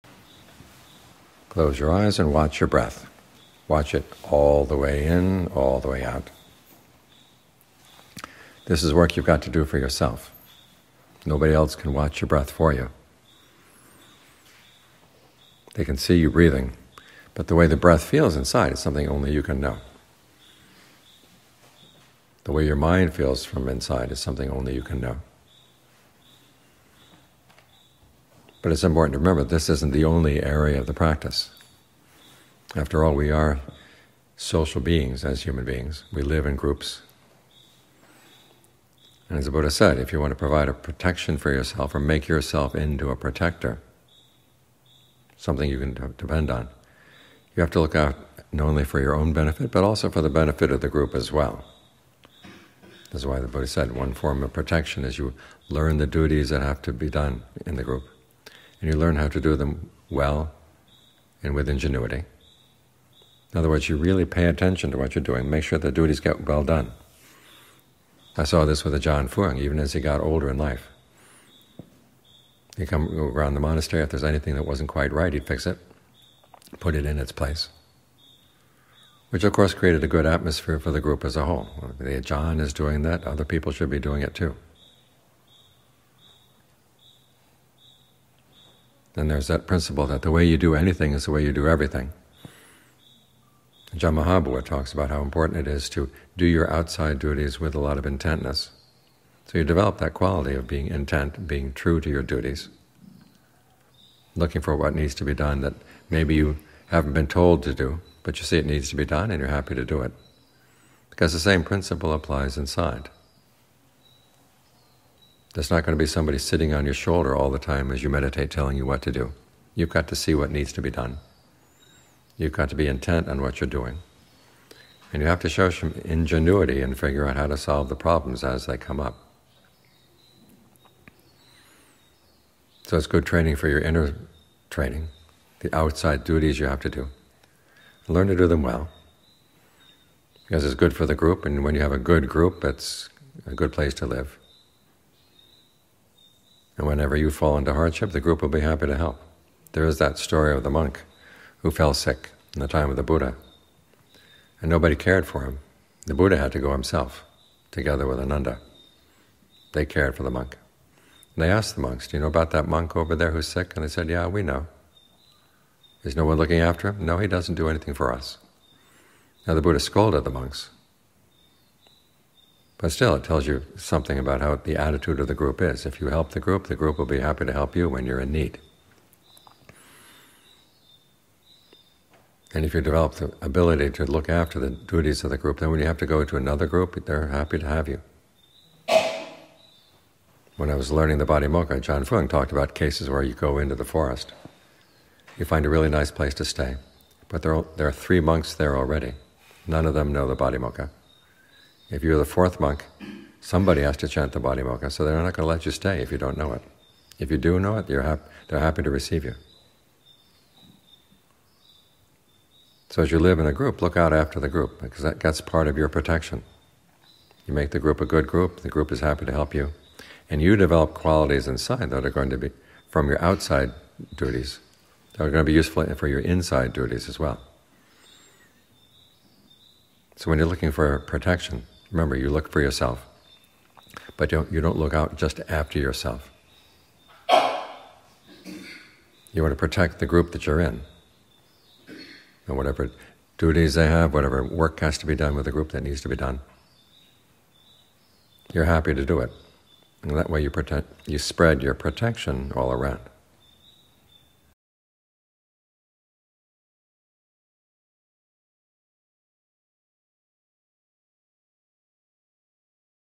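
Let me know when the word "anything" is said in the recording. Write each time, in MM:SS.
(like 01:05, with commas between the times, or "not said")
01:14, 01:30, 02:47.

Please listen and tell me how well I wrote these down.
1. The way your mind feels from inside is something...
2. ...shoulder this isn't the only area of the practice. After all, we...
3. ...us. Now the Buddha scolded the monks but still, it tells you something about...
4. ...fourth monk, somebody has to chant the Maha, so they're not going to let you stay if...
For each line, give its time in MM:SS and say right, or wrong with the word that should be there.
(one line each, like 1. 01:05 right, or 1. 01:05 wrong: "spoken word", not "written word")
1. 00:22 right
2. 00:29 wrong: "remember", not "shoulder"
3. 02:48 right
4. 03:22 wrong: "Patimokkha", not "Maha".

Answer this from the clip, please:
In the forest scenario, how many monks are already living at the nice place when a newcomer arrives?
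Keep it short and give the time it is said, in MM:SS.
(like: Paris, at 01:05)
3, at 03:17.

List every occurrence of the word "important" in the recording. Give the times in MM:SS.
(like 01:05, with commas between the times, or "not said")
00:28, 01:35.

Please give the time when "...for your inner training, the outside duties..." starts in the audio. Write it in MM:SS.
02:13.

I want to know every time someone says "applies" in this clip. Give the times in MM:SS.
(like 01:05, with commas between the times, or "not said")
01:52.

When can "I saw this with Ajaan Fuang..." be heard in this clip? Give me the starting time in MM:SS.
01:08.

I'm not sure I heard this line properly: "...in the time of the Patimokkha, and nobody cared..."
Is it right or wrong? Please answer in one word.
wrong.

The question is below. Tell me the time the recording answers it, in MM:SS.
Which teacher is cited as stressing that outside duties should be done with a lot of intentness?
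01:33.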